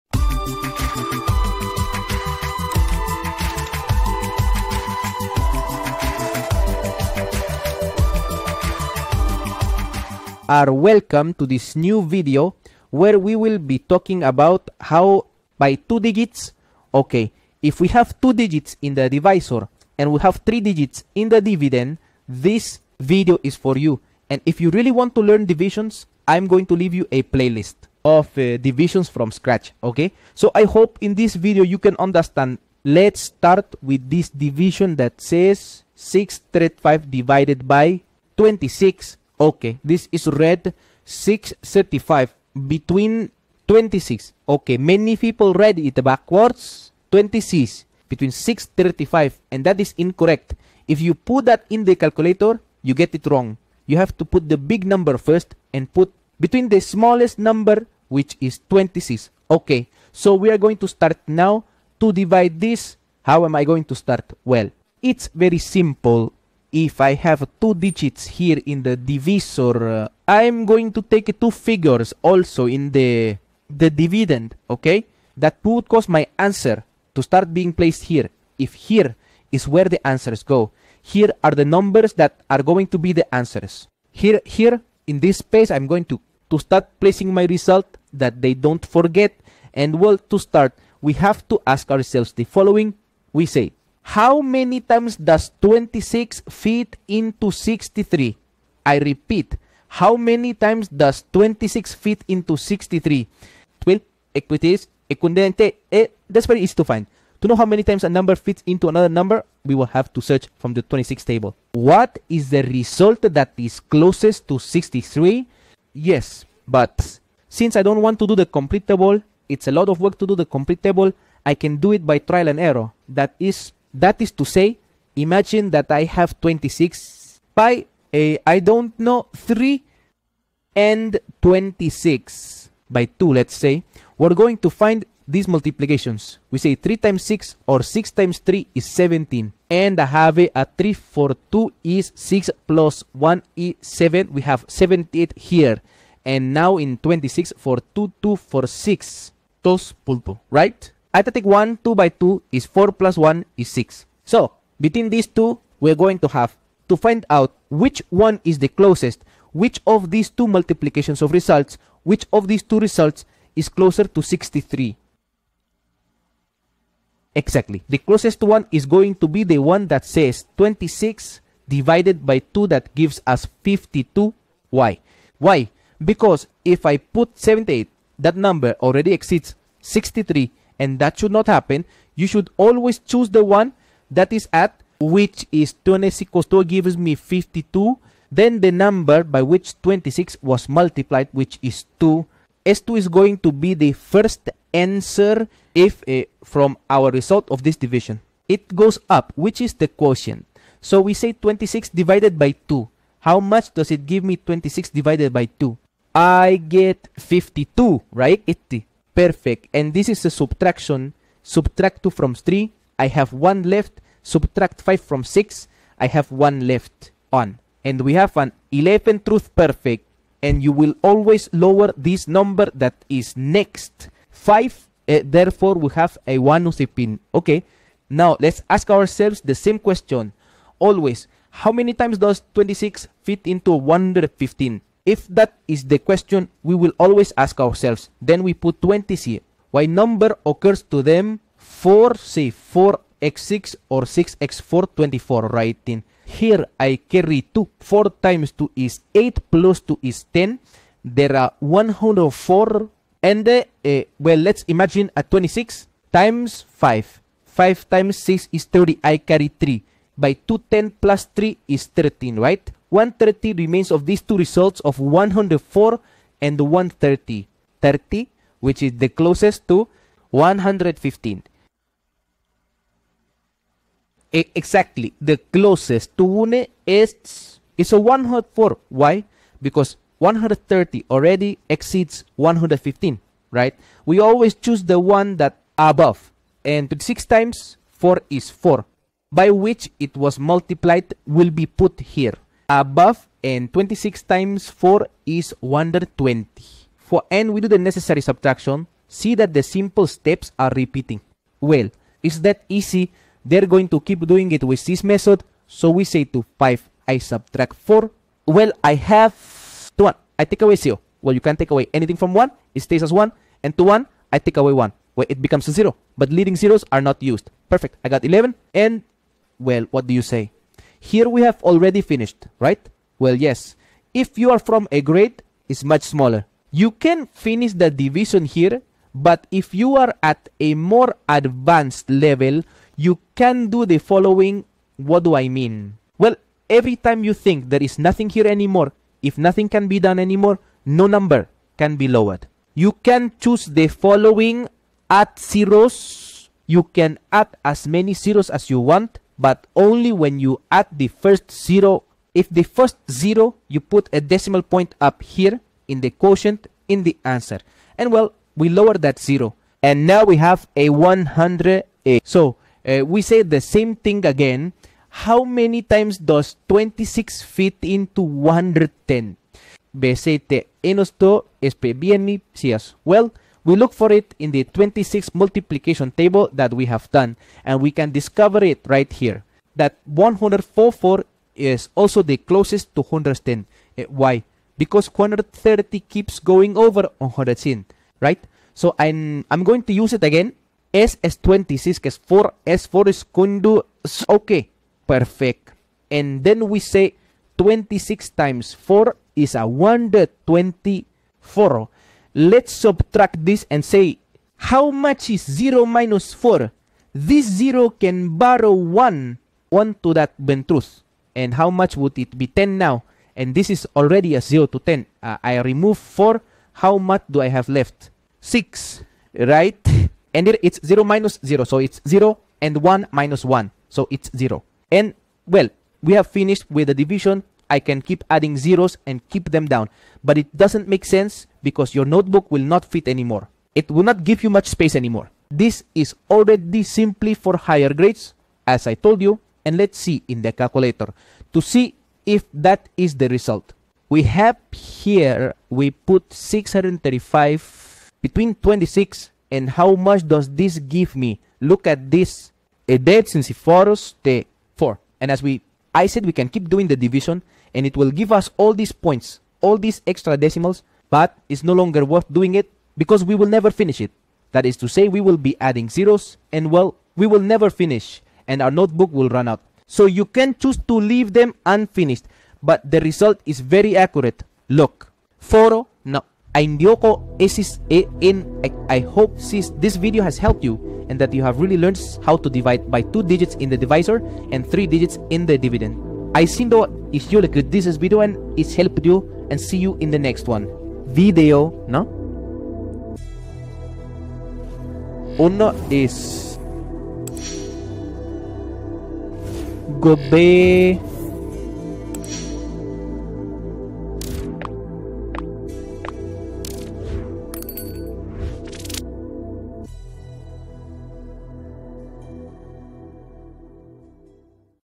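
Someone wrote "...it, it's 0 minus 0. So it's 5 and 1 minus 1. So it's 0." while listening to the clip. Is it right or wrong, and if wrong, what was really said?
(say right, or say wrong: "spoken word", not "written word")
wrong: "0", not "5".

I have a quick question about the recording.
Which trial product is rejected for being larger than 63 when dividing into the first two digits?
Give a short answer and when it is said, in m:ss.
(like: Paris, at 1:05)
78, at 2:24.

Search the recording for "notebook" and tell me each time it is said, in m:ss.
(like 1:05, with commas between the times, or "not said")
7:12, 7:48.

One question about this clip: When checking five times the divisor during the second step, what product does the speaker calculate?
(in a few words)
130.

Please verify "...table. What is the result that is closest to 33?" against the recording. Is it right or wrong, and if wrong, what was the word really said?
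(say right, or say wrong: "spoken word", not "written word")
wrong: "63", not "33".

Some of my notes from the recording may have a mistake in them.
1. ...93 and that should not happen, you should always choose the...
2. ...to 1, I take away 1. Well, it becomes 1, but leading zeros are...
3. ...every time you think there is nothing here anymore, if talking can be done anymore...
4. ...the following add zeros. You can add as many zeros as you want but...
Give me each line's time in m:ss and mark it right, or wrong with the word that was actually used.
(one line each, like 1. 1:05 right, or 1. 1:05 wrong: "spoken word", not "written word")
1. 2:59 wrong: "63", not "93"
2. 5:13 wrong: "0", not "1"
3. 5:36 wrong: "nothing", not "talking"
4. 5:43 right.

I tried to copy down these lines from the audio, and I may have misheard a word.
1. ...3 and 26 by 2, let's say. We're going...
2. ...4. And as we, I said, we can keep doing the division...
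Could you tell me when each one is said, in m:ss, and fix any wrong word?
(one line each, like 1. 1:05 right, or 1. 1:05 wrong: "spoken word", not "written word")
1. 2:09 right
2. 7:34 right.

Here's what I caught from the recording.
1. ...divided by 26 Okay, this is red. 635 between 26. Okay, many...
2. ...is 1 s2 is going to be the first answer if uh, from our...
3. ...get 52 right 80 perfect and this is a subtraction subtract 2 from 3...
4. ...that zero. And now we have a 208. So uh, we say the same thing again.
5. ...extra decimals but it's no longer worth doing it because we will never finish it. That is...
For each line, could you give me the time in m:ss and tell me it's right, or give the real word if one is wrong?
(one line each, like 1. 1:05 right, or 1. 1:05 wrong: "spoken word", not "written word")
1. 0:37 right
2. 3:11 wrong: "2", not "1"
3. 3:26 right
4. 5:58 wrong: "108", not "208"
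5. 7:40 right.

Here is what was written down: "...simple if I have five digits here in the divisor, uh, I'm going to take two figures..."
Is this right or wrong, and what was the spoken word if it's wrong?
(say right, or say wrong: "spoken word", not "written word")
wrong: "two", not "five".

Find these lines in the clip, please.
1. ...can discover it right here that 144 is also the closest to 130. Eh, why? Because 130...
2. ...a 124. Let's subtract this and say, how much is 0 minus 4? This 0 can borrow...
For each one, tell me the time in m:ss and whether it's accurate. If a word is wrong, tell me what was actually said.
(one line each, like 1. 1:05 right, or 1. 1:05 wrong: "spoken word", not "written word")
1. 6:17 wrong: "110", not "130"
2. 6:39 right.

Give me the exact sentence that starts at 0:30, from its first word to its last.
So I hope in this video you can understand.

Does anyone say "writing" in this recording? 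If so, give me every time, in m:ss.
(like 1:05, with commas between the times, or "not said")
4:05.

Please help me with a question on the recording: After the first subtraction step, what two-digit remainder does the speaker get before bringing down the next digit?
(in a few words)
11.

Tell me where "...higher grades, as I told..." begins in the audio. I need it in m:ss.
7:17.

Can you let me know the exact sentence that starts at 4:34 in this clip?
E exactly, the closest to 1 is, is a 104.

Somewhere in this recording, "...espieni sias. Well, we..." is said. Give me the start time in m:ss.
6:11.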